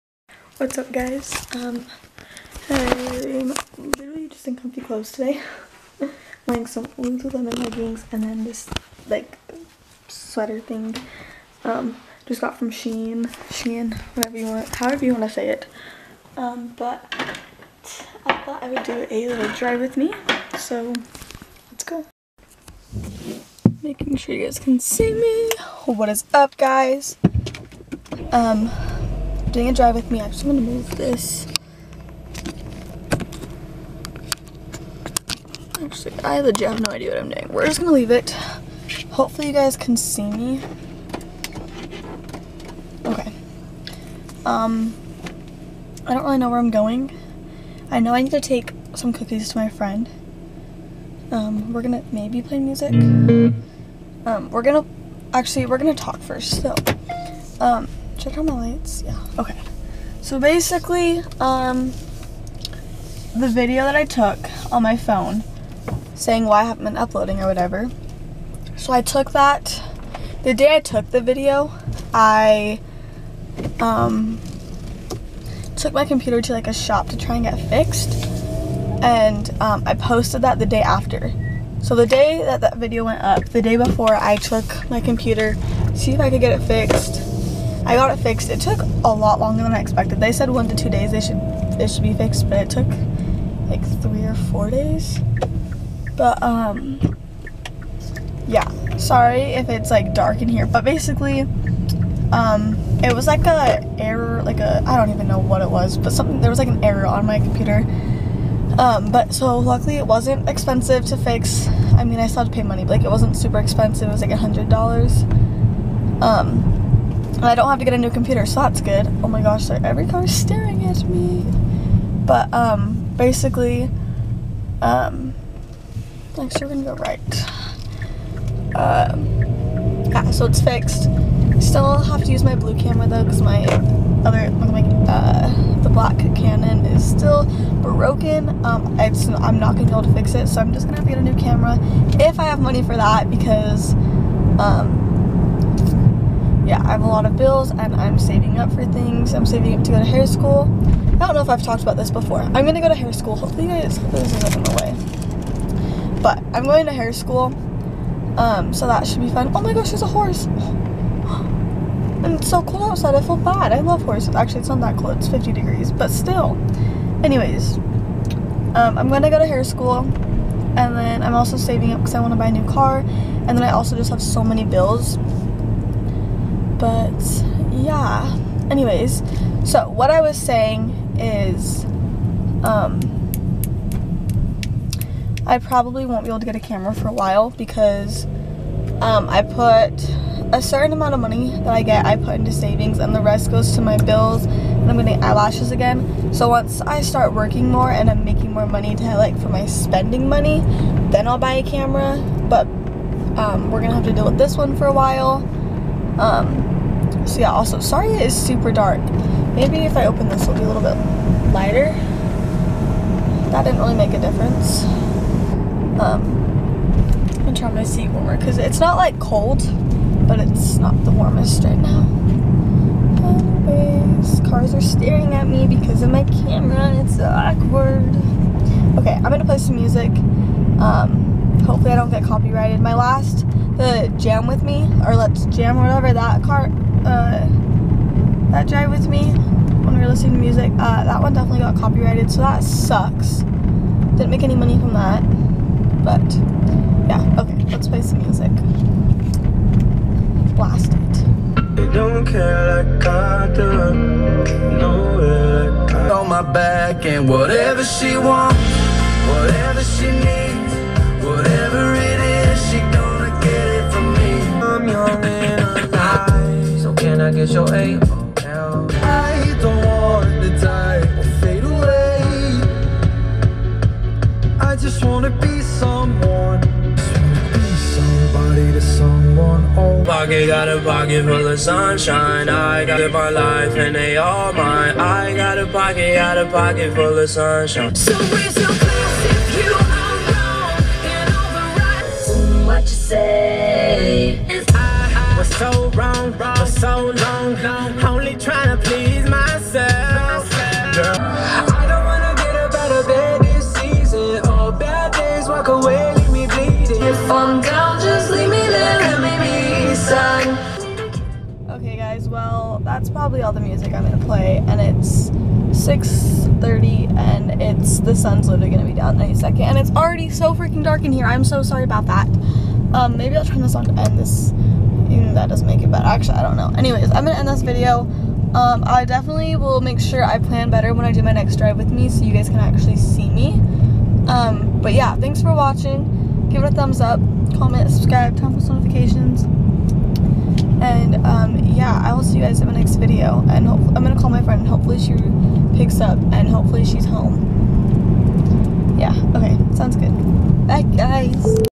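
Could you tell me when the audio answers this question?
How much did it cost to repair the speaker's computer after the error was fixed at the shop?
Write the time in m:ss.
1:54.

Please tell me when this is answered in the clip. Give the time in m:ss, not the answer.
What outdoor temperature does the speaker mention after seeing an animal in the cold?
2:45.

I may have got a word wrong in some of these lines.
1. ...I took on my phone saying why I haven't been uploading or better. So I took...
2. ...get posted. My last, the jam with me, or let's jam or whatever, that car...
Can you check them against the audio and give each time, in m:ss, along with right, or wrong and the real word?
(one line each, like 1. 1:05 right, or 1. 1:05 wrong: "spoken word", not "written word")
1. 1:03 wrong: "whatever", not "better"
2. 3:52 wrong: "copyrighted", not "posted".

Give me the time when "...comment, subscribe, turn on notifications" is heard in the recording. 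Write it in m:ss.
5:37.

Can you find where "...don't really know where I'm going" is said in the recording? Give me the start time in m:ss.
0:46.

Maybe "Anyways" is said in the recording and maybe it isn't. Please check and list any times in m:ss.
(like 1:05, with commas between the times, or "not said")
2:47, 2:58, 3:43, 5:26.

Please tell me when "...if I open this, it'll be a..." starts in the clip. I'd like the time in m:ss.
3:29.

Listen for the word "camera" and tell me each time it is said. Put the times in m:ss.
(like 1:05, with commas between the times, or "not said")
2:12, 2:21, 3:06, 3:21, 3:46.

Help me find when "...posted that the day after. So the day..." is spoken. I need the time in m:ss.
1:19.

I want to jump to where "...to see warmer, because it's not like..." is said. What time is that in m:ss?
3:37.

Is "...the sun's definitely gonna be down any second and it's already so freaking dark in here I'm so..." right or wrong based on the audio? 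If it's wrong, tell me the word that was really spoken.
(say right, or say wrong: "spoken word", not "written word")
wrong: "literally", not "definitely".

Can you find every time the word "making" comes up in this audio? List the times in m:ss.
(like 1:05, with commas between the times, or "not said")
0:23, 3:18.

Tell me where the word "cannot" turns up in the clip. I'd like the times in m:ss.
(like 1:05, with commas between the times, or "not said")
not said.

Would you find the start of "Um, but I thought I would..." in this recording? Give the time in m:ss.
0:16.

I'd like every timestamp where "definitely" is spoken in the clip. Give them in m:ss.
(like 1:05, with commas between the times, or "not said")
4:01, 5:29.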